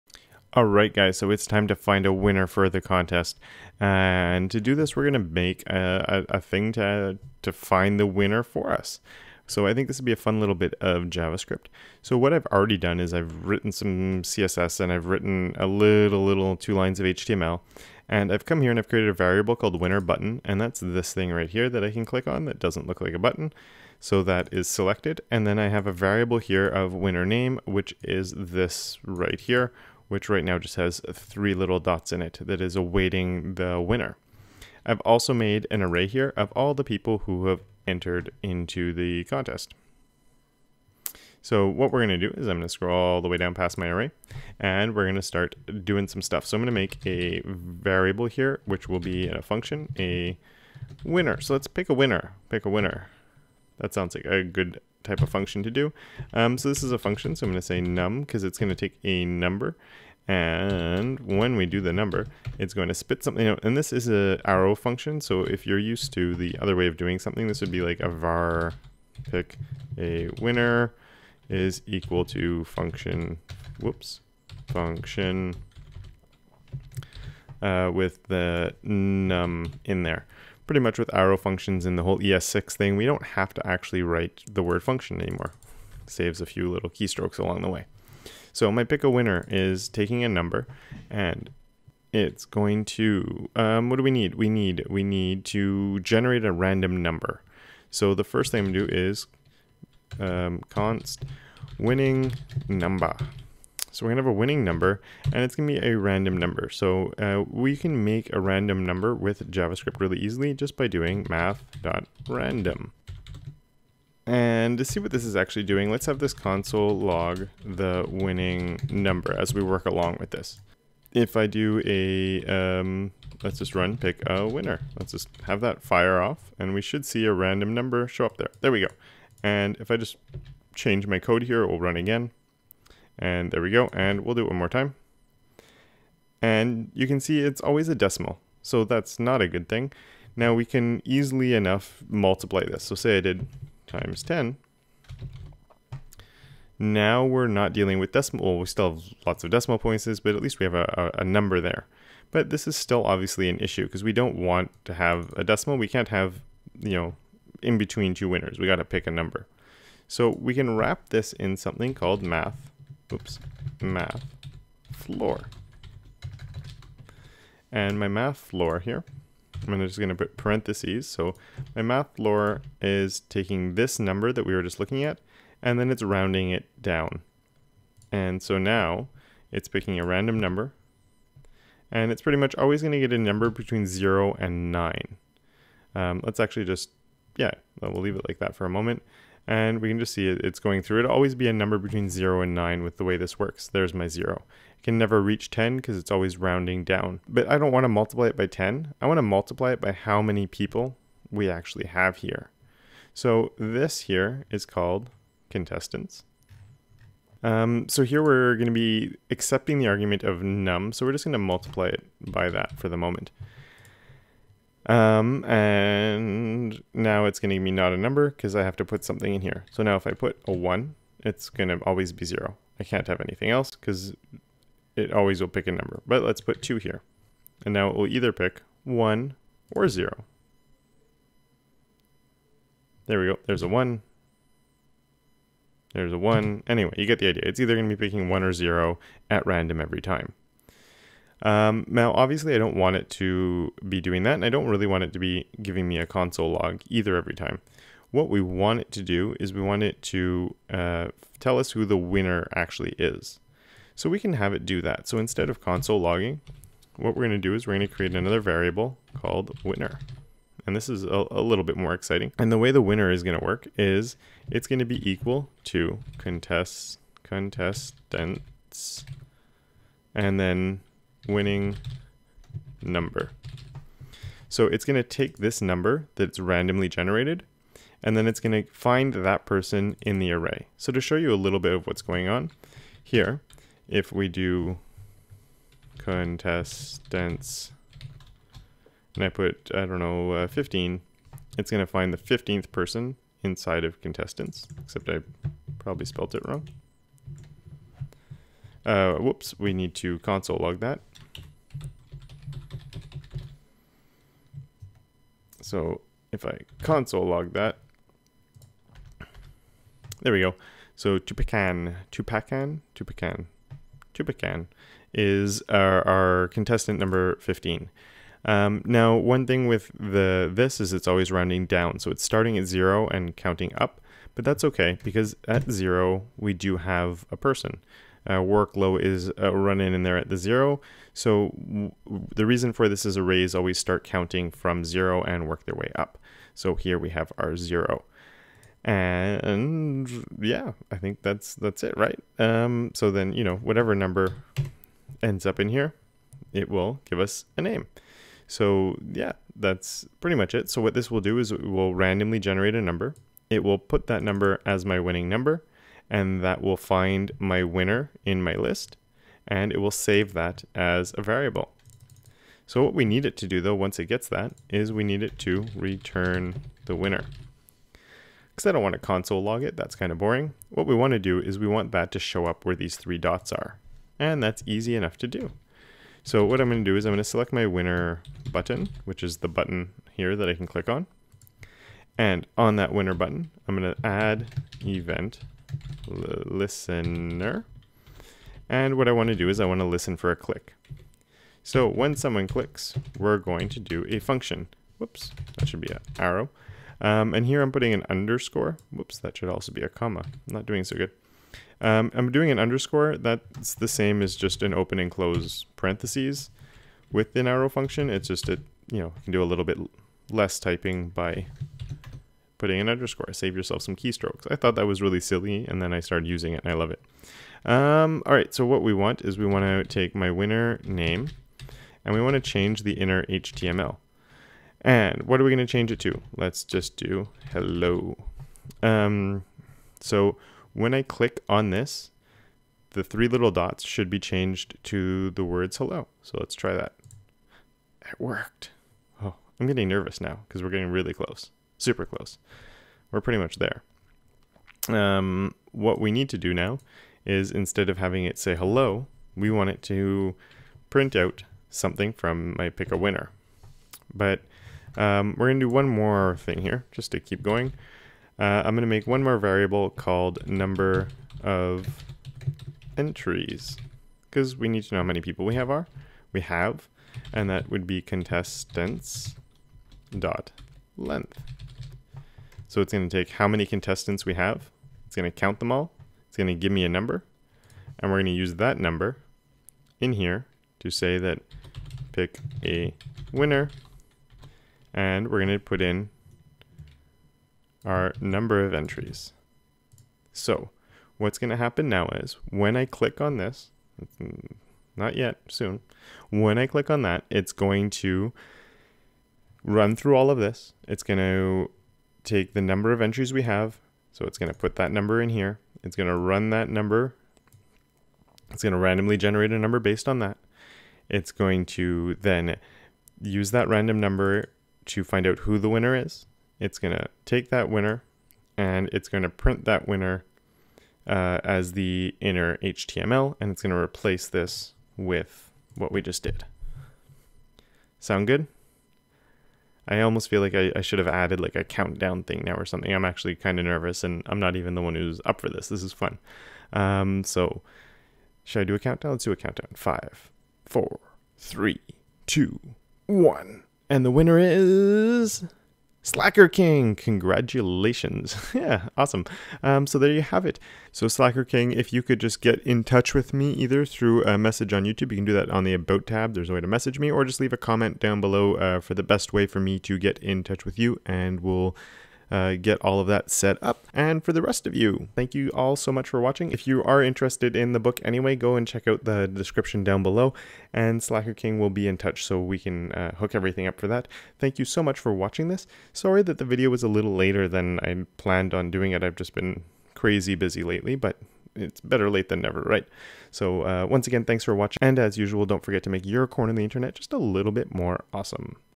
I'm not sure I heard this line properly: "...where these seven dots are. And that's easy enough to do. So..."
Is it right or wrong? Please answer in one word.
wrong.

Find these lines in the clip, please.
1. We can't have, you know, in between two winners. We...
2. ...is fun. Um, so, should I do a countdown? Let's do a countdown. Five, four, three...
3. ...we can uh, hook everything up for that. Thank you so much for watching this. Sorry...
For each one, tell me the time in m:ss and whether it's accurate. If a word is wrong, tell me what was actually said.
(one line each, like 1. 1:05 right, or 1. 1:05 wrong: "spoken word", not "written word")
1. 2:35 right
2. 8:55 right
3. 9:32 right.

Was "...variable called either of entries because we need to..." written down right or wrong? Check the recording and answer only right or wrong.
wrong.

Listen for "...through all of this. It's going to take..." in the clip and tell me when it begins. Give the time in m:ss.
8:19.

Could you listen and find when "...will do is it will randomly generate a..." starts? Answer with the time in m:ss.
5:51.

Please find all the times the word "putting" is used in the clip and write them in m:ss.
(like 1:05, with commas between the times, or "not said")
6:37, 6:52.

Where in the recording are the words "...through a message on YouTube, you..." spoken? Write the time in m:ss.
9:13.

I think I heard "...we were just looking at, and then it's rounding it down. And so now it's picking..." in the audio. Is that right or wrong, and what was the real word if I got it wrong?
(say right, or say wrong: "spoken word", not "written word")
right.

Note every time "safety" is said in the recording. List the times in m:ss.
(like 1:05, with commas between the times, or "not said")
not said.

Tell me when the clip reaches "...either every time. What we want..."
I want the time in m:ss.
4:06.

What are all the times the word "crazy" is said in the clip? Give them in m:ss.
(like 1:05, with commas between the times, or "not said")
9:39.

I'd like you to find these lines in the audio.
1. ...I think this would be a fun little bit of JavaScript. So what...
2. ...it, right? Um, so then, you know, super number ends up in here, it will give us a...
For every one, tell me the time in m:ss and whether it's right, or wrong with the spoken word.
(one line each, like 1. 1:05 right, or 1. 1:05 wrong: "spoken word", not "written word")
1. 0:09 right
2. 5:41 wrong: "whatever", not "super".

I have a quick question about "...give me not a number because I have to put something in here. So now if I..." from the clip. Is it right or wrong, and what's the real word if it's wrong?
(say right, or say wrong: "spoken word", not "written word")
right.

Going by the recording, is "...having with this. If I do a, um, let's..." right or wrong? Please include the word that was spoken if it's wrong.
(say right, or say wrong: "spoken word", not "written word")
wrong: "along", not "having".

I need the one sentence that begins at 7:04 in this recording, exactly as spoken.
And what are we going to change it to?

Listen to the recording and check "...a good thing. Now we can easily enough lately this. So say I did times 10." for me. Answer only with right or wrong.
wrong.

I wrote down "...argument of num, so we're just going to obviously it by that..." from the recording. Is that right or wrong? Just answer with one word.
wrong.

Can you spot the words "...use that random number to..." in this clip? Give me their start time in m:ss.
8:33.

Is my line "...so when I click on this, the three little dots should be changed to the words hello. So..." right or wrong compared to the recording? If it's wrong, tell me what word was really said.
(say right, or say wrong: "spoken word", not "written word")
right.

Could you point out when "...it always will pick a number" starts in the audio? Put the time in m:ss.
3:44.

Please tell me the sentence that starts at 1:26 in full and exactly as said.
Saves a few little keystrokes along the way.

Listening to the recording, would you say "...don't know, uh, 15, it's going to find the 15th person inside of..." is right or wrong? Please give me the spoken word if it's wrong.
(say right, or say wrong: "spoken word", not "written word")
right.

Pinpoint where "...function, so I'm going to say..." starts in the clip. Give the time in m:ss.
0:56.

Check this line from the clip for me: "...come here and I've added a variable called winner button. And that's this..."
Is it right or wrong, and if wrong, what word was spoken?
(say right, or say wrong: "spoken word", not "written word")
wrong: "created", not "added".